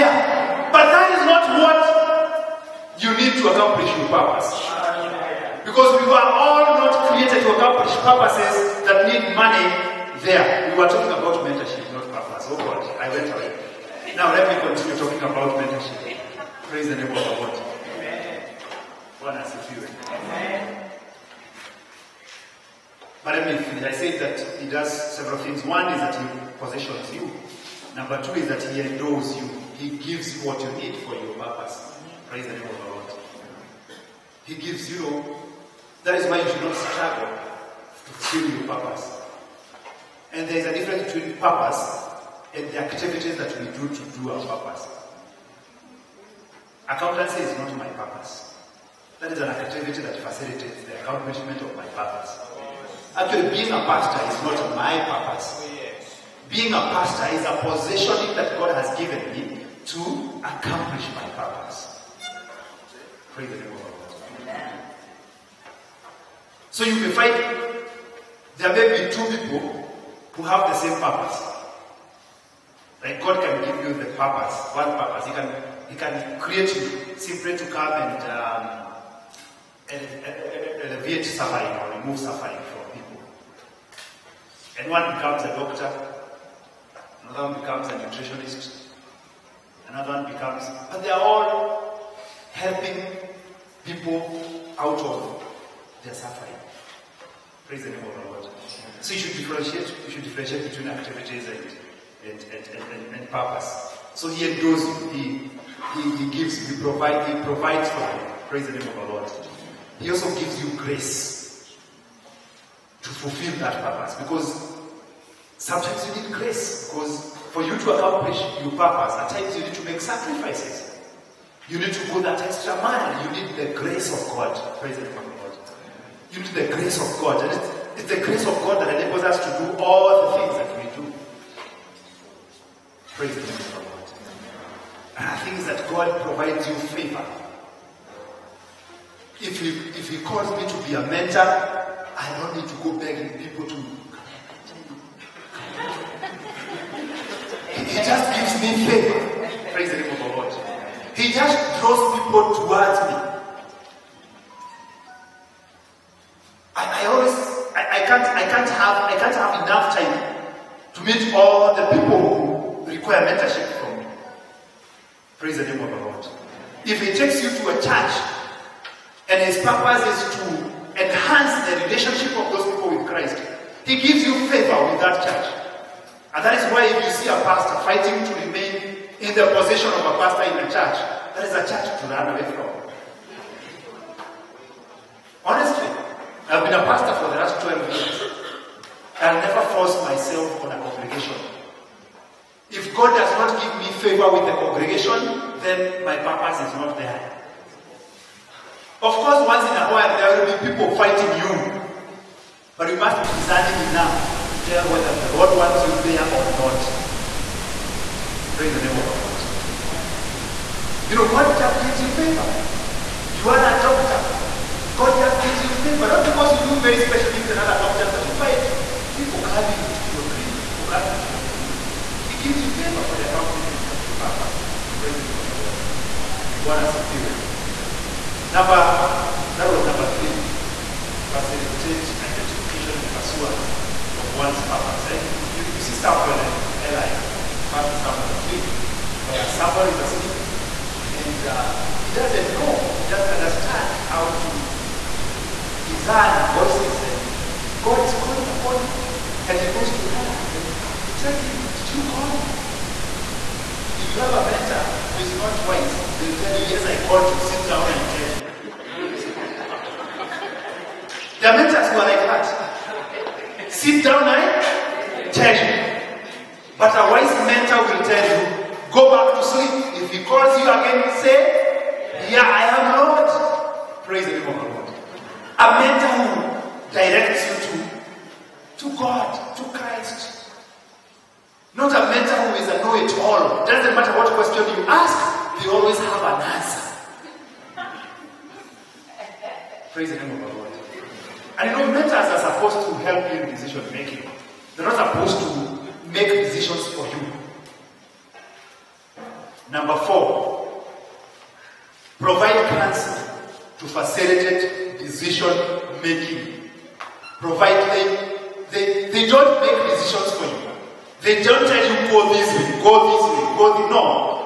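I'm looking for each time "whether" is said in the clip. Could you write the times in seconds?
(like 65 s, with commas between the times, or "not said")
204 s.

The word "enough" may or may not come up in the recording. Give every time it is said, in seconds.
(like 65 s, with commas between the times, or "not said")
159 s, 203 s.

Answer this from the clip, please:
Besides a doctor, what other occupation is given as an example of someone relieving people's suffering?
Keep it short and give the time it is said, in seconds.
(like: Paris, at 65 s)
Nutritionist, at 87 s.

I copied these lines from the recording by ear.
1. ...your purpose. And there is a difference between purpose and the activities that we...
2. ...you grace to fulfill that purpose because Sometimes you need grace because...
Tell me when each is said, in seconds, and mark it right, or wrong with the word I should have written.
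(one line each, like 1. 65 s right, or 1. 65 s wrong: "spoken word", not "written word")
1. 38 s right
2. 110 s right.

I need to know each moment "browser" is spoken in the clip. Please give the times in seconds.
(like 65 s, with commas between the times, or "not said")
not said.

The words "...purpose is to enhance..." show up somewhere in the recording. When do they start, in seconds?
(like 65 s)
169 s.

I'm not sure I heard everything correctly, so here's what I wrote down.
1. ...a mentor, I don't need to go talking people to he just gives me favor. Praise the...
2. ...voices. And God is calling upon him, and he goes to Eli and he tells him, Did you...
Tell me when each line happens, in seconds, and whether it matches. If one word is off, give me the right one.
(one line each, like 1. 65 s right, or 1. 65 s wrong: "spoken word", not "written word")
1. 140 s wrong: "begging", not "talking"
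2. 246 s right.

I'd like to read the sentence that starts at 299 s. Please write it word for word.
Number four, provide counsel to facilitate decision making.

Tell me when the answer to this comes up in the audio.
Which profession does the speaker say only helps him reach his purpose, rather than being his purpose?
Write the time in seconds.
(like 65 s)
46 s.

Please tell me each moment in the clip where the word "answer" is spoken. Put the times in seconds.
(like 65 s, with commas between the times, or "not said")
287 s.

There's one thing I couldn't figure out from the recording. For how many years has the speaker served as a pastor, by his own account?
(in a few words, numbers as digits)
12.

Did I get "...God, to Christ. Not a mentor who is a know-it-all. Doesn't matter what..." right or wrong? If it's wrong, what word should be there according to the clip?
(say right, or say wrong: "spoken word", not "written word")
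right.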